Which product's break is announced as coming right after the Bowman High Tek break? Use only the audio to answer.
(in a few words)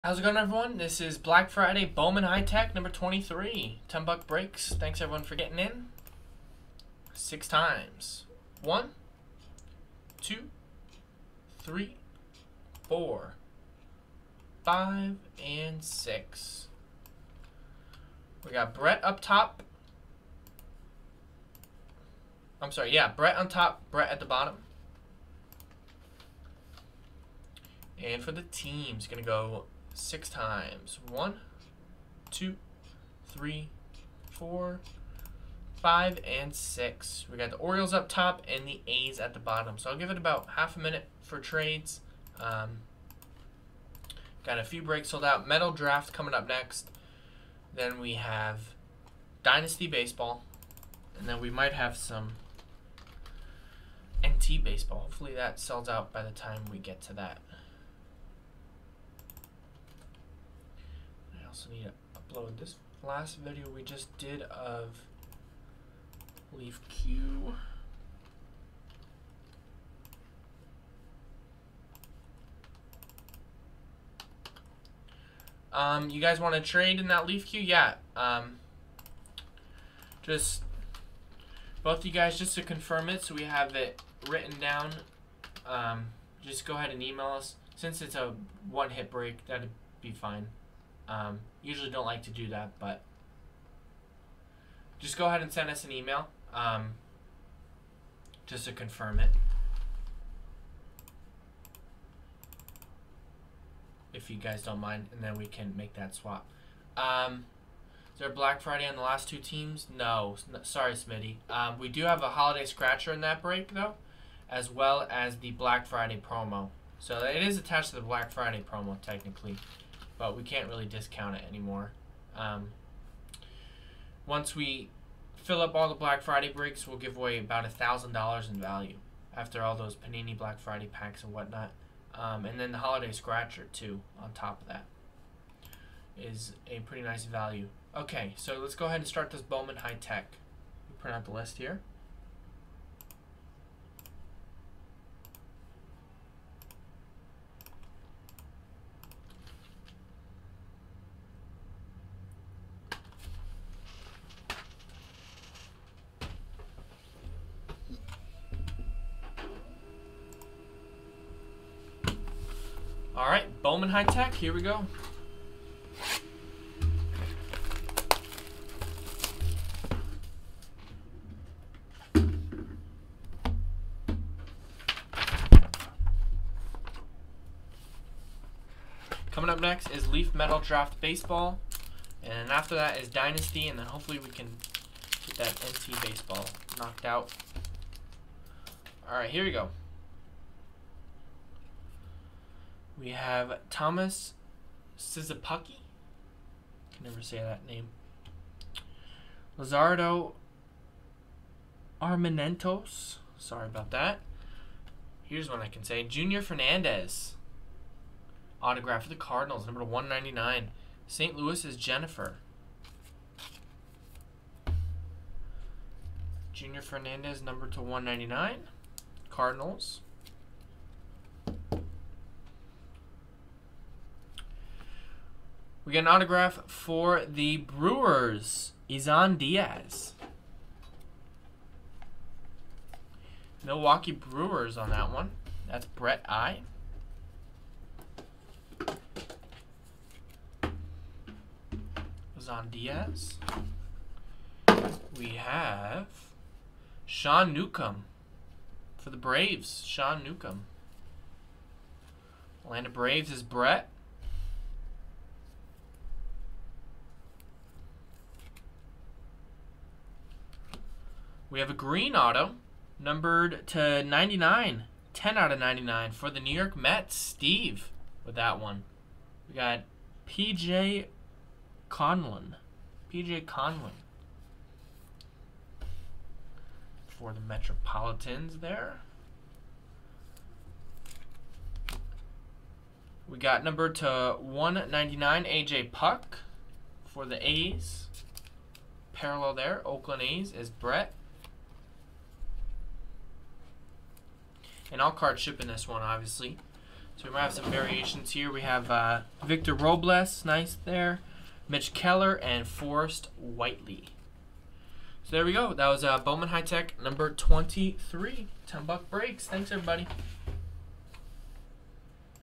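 Leaf Metal Draft Baseball.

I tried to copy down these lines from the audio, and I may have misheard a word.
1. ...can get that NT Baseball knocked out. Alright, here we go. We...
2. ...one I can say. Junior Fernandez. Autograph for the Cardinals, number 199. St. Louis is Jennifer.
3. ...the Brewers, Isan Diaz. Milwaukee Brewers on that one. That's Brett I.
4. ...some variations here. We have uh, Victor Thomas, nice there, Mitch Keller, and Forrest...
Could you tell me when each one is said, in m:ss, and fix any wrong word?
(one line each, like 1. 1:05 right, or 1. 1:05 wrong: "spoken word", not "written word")
1. 3:04 right
2. 3:25 right
3. 3:47 right
4. 4:57 wrong: "Robles", not "Thomas".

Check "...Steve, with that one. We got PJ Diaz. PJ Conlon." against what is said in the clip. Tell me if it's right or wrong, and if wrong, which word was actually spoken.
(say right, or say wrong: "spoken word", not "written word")
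wrong: "Conlon", not "Diaz".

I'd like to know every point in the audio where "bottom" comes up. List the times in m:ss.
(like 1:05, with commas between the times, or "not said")
0:24, 0:39.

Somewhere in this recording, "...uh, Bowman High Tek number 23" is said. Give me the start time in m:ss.
5:06.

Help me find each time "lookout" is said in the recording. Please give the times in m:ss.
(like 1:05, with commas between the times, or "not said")
not said.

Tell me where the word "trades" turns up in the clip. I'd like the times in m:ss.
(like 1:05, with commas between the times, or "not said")
0:41, 1:16.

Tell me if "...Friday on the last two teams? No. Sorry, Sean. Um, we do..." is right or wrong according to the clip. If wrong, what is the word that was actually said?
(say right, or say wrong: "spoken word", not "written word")
wrong: "Smitty", not "Sean".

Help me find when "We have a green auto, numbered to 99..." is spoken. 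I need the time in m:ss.
4:21.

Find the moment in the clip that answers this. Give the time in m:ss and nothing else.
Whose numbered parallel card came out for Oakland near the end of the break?
4:45.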